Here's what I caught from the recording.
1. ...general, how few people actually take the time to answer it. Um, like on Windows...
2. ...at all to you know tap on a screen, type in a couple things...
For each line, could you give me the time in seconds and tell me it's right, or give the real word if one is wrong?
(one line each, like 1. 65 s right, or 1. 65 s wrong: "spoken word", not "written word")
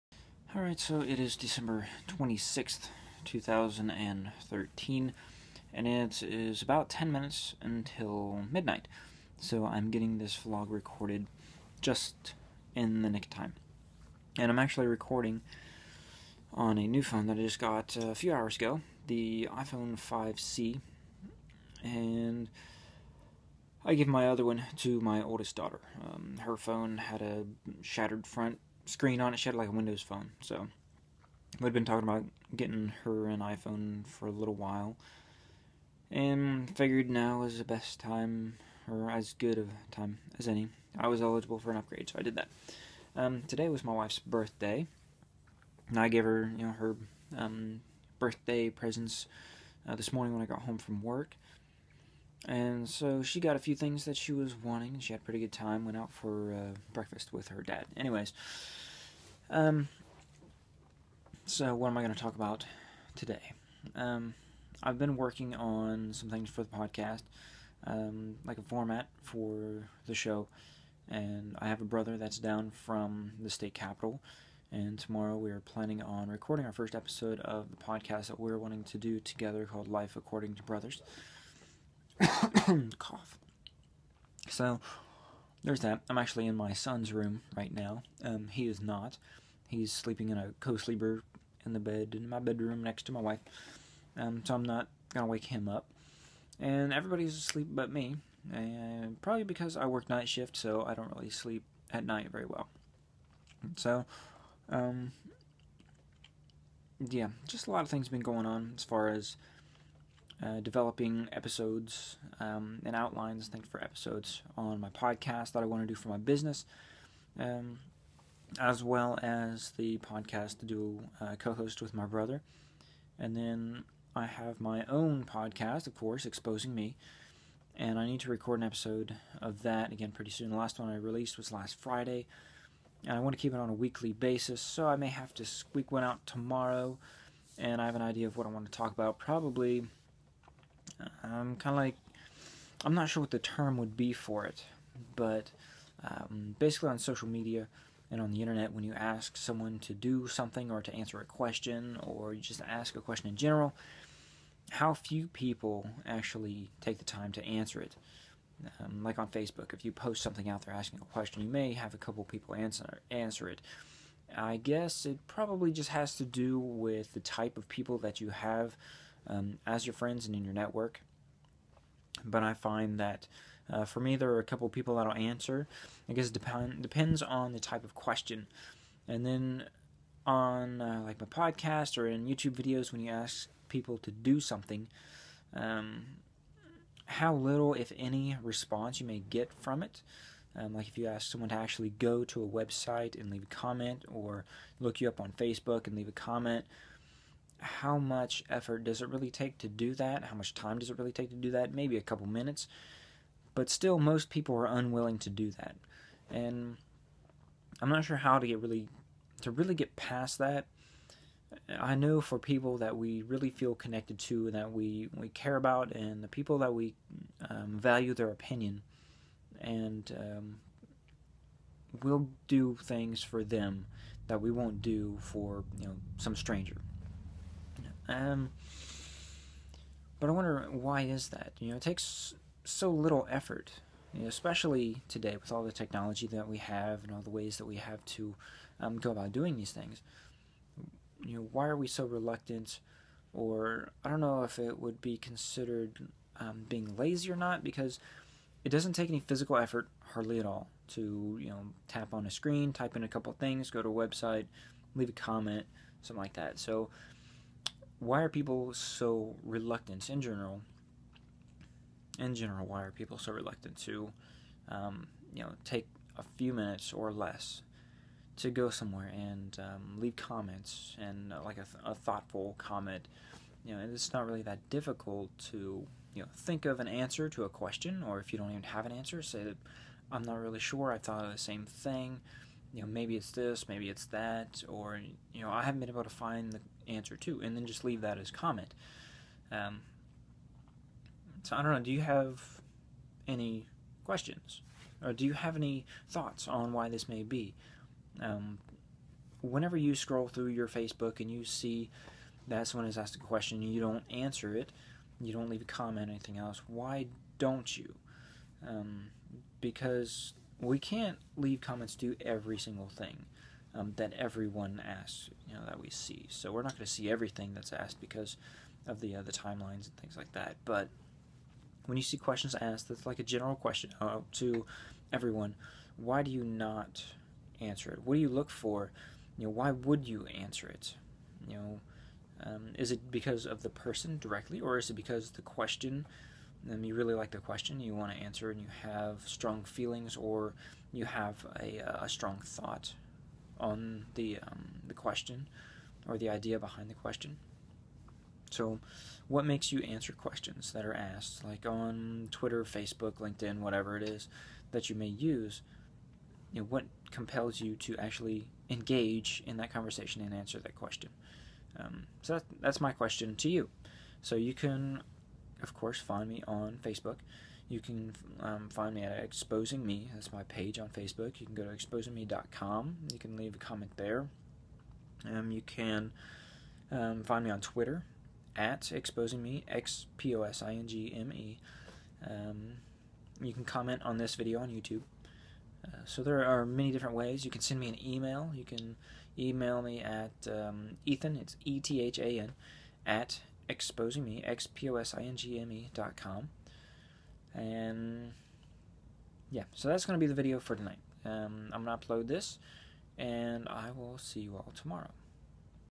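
1. 153 s wrong: "Facebook", not "Windows"
2. 250 s right.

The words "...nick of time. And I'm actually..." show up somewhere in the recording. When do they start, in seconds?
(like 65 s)
13 s.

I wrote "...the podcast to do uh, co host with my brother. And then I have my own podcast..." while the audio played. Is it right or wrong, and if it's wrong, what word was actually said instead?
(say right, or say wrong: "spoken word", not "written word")
right.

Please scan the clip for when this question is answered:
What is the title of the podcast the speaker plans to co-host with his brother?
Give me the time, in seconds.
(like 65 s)
79 s.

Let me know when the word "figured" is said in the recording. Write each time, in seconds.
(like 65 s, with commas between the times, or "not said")
36 s.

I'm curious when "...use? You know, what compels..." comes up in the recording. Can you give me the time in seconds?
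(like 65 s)
355 s.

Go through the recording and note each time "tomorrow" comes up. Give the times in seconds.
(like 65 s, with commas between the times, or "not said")
74 s, 136 s, 404 s.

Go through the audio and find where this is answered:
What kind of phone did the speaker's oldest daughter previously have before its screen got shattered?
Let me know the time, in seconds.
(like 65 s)
29 s.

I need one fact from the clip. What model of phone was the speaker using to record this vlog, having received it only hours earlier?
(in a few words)
iPhone 5C.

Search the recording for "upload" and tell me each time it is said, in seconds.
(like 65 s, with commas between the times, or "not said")
402 s.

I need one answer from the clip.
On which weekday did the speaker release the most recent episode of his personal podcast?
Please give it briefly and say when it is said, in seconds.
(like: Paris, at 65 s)
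Friday, at 131 s.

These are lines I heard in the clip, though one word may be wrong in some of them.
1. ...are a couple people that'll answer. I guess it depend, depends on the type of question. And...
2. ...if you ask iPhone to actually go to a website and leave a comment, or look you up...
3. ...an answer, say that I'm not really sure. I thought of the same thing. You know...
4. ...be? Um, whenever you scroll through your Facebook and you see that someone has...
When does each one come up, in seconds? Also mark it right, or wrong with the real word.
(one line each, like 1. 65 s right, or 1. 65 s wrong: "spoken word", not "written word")
1. 174 s right
2. 190 s wrong: "someone", not "iPhone"
3. 278 s right
4. 297 s right.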